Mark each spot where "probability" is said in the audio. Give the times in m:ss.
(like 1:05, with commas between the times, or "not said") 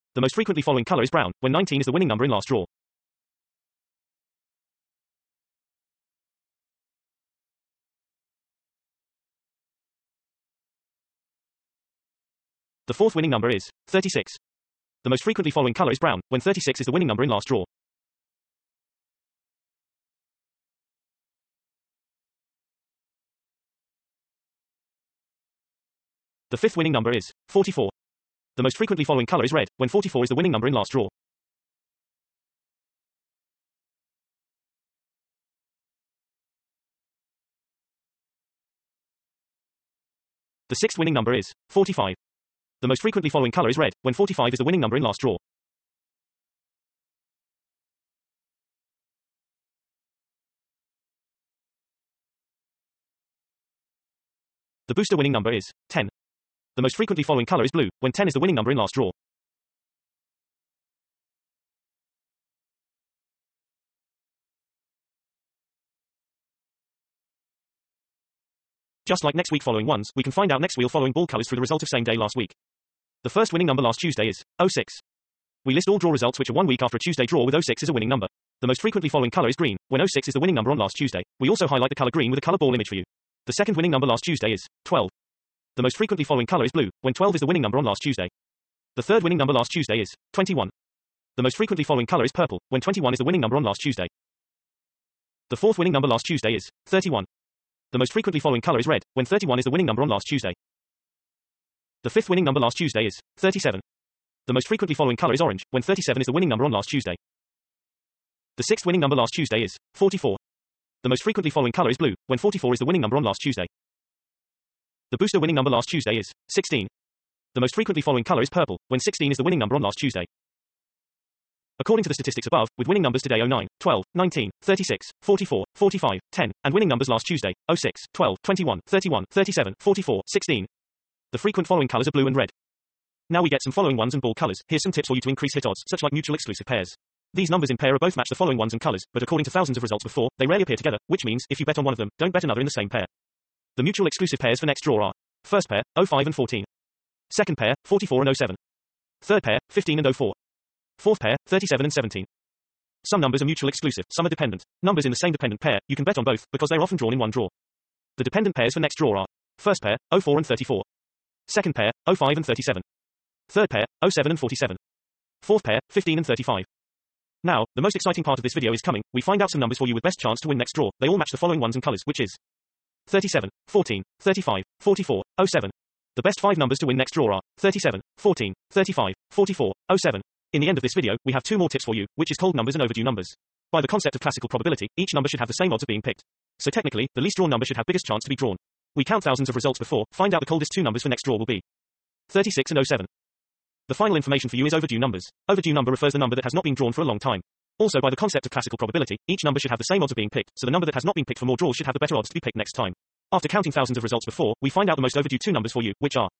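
3:04, 3:18.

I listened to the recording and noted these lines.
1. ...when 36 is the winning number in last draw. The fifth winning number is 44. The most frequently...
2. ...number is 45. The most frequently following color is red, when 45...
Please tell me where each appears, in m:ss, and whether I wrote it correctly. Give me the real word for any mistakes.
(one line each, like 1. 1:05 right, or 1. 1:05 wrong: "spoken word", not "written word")
1. 0:16 right
2. 0:41 right.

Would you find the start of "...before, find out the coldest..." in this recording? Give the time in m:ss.
3:09.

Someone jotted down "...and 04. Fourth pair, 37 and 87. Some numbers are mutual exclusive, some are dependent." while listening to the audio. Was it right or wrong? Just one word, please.
wrong.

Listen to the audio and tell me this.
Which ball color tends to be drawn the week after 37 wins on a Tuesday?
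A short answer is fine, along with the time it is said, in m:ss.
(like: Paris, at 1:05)
Orange, at 1:45.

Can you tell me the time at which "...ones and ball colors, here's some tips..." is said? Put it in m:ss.
2:13.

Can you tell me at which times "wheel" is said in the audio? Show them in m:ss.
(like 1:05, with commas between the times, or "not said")
1:10.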